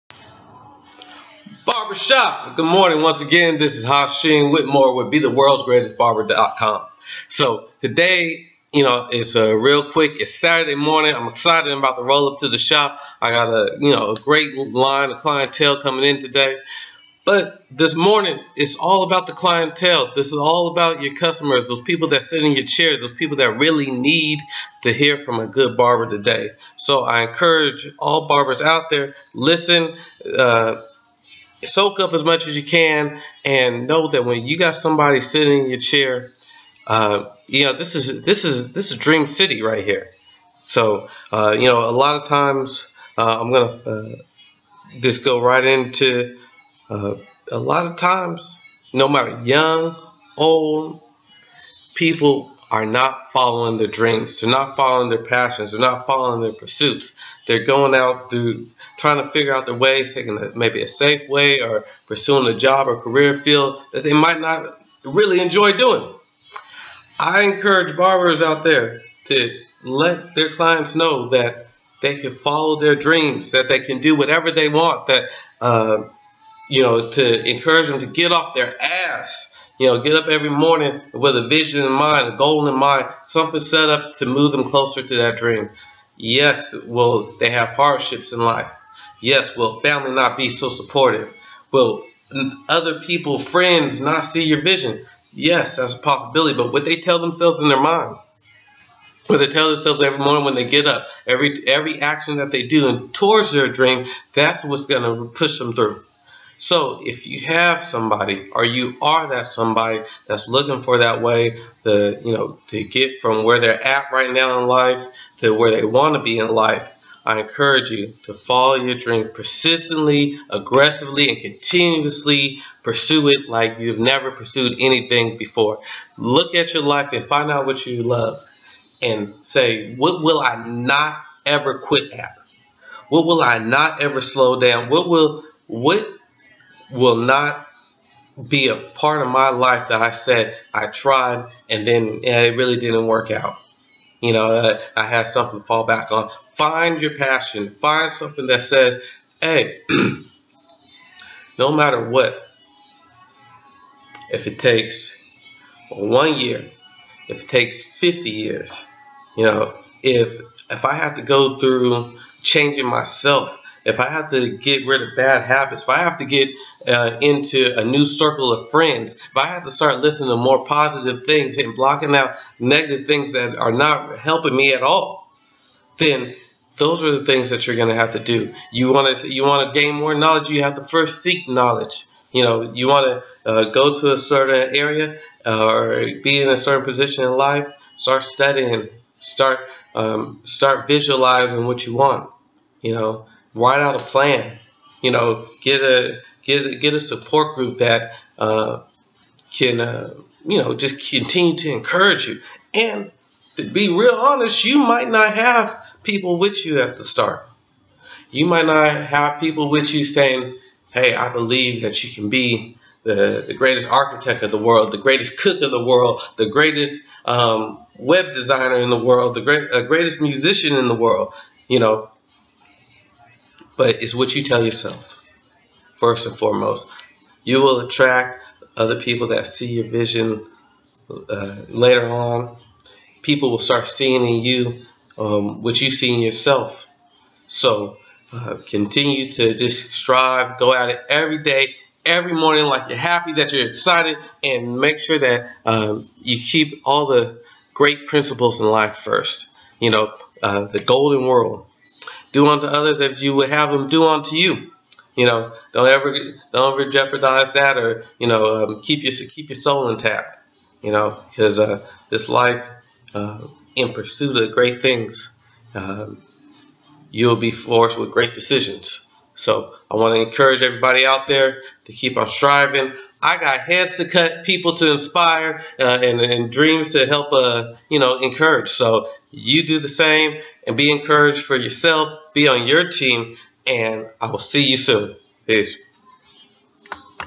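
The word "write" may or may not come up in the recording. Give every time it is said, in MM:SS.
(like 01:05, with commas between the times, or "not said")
03:13.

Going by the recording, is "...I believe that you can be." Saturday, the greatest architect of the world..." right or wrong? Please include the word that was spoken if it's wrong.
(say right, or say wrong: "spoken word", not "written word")
wrong: "The", not "Saturday".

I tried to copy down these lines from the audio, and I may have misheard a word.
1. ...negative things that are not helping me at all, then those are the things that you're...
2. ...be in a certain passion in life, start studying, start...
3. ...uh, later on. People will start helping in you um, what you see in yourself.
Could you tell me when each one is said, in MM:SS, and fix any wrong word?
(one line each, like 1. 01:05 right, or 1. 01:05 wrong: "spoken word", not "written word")
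1. 02:52 right
2. 03:06 wrong: "position", not "passion"
3. 03:51 wrong: "seeing", not "helping".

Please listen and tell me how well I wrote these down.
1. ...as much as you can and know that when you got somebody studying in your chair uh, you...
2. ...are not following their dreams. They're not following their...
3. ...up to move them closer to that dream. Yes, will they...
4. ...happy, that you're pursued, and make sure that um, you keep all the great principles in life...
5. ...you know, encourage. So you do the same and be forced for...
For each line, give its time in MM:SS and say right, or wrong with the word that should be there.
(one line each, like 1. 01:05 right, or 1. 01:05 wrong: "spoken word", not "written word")
1. 00:32 wrong: "sitting", not "studying"
2. 00:52 right
3. 01:23 right
4. 04:02 wrong: "excited", not "pursued"
5. 04:37 wrong: "encouraged", not "forced".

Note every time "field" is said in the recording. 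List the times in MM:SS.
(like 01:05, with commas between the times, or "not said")
01:03.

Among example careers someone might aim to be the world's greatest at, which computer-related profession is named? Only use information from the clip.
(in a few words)
web designer.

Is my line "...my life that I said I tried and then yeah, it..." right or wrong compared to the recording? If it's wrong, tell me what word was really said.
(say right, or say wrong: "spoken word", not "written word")
right.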